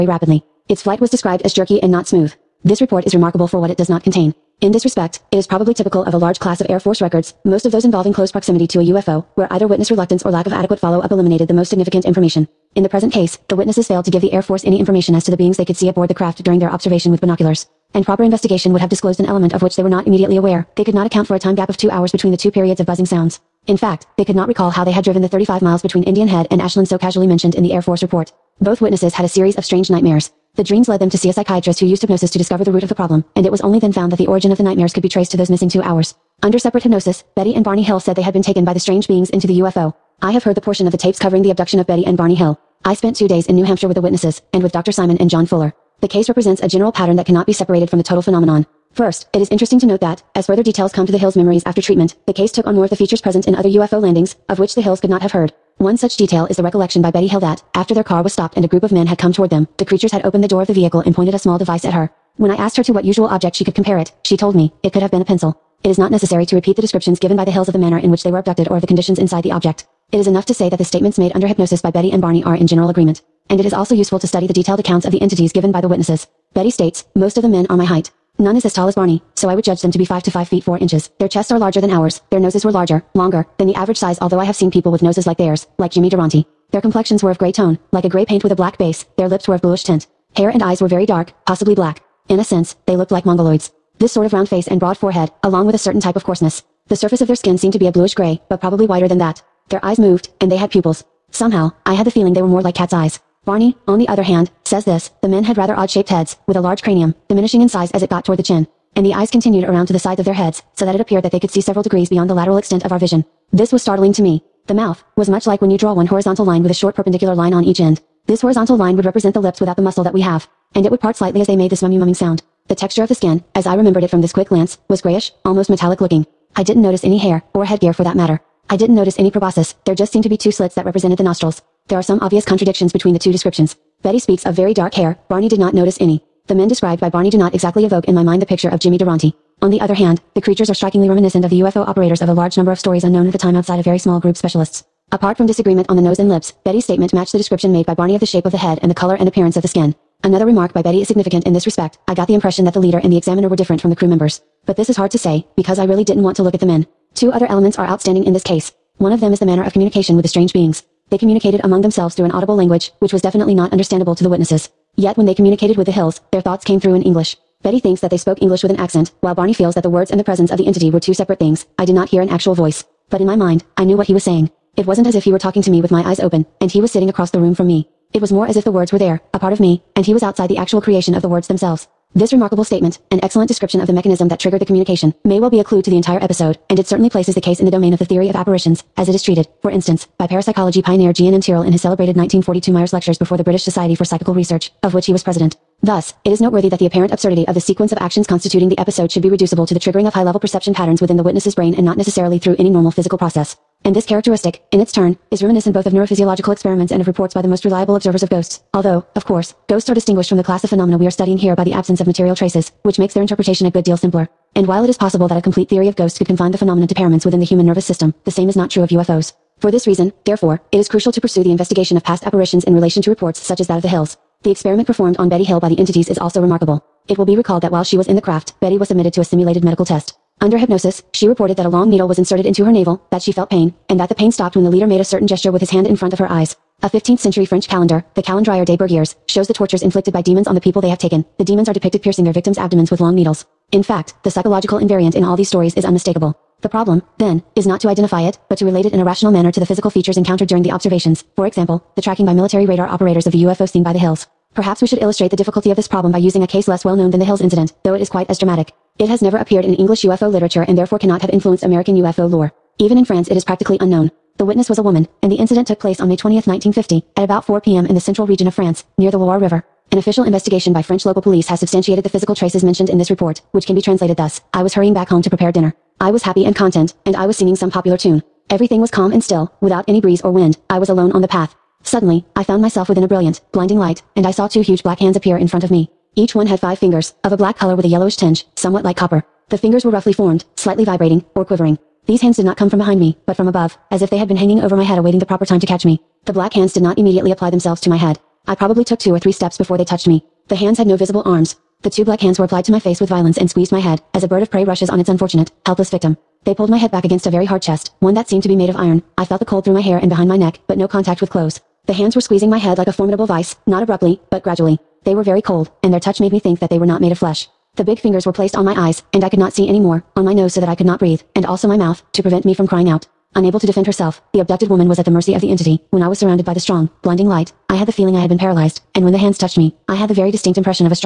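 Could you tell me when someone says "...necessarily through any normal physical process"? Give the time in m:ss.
3:21.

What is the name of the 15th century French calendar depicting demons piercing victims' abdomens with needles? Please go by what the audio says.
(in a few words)
Calendrier des Bergiers.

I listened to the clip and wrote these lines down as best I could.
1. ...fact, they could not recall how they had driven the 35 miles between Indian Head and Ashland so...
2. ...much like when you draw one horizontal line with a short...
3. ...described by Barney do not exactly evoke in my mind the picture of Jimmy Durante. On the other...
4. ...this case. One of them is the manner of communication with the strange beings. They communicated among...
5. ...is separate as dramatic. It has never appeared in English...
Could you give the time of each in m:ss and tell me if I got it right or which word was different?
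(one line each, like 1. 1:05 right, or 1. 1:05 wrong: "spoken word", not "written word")
1. 0:23 right
2. 1:55 right
3. 2:16 right
4. 2:38 right
5. 4:18 wrong: "quite", not "separate".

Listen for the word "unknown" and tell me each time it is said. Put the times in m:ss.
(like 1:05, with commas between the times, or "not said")
2:23, 4:23.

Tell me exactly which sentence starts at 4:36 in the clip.
I was happy and content, and I was singing some popular tune.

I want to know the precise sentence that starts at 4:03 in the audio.
In fact, the psychological invariant in all these stories is unmistakable.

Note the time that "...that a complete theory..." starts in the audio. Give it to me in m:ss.
3:35.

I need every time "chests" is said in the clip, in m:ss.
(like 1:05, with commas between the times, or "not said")
1:21, 5:07.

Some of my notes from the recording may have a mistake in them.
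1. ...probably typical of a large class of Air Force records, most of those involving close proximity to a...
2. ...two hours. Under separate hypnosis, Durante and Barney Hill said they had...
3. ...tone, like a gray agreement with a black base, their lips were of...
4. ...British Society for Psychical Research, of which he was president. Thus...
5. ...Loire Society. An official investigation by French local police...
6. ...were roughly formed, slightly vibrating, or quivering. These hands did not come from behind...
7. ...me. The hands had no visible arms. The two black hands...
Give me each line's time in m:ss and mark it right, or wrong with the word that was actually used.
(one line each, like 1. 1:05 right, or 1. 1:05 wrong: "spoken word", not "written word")
1. 0:05 right
2. 0:35 wrong: "Betty", not "Durante"
3. 1:27 wrong: "paint", not "agreement"
4. 3:13 right
5. 4:29 wrong: "River", not "Society"
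6. 4:49 right
7. 5:00 right.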